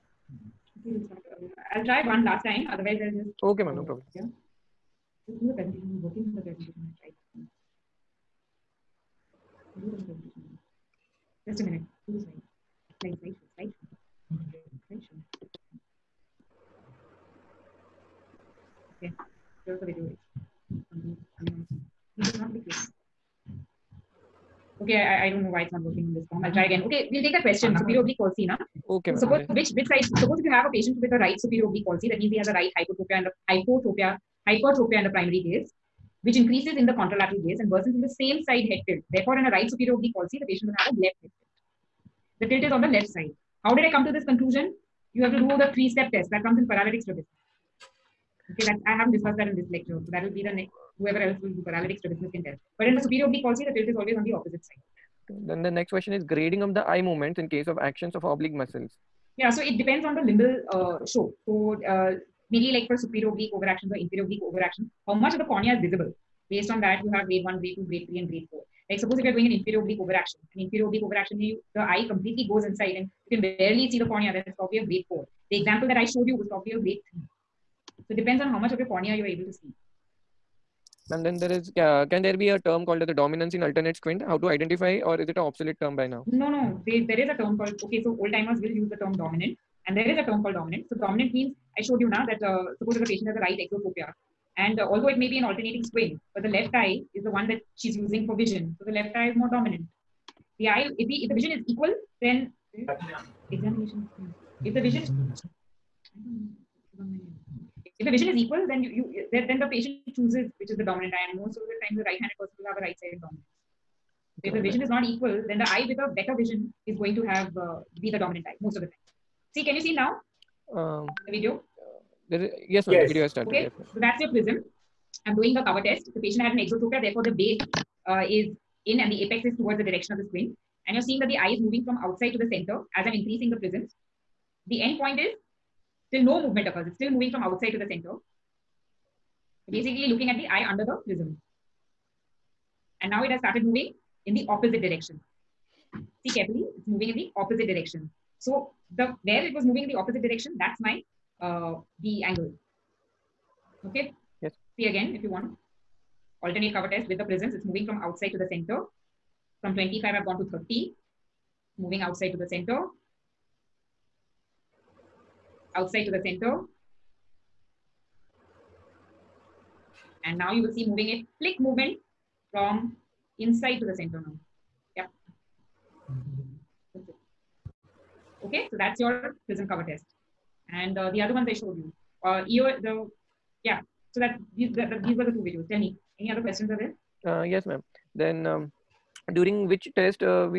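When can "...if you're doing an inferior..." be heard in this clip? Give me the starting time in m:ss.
1:09.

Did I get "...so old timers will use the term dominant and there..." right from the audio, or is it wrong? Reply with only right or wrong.
right.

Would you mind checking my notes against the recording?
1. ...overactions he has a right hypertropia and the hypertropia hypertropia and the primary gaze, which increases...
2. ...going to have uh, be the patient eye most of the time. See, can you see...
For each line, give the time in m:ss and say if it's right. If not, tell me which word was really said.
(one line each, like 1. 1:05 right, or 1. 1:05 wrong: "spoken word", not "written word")
1. 0:32 wrong: "means", not "overactions"
2. 1:56 wrong: "dominant", not "patient".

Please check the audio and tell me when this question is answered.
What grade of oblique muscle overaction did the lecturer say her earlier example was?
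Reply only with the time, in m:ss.
1:16.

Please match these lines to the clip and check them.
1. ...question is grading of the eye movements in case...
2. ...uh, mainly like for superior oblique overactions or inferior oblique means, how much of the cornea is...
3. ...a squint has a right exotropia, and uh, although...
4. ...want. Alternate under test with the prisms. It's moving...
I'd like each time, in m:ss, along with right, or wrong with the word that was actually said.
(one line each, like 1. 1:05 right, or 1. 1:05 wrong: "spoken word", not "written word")
1. 0:55 right
2. 1:01 wrong: "overactions", not "means"
3. 1:33 wrong: "patient", not "squint"
4. 2:35 wrong: "cover", not "under".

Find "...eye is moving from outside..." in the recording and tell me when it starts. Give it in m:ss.
2:11.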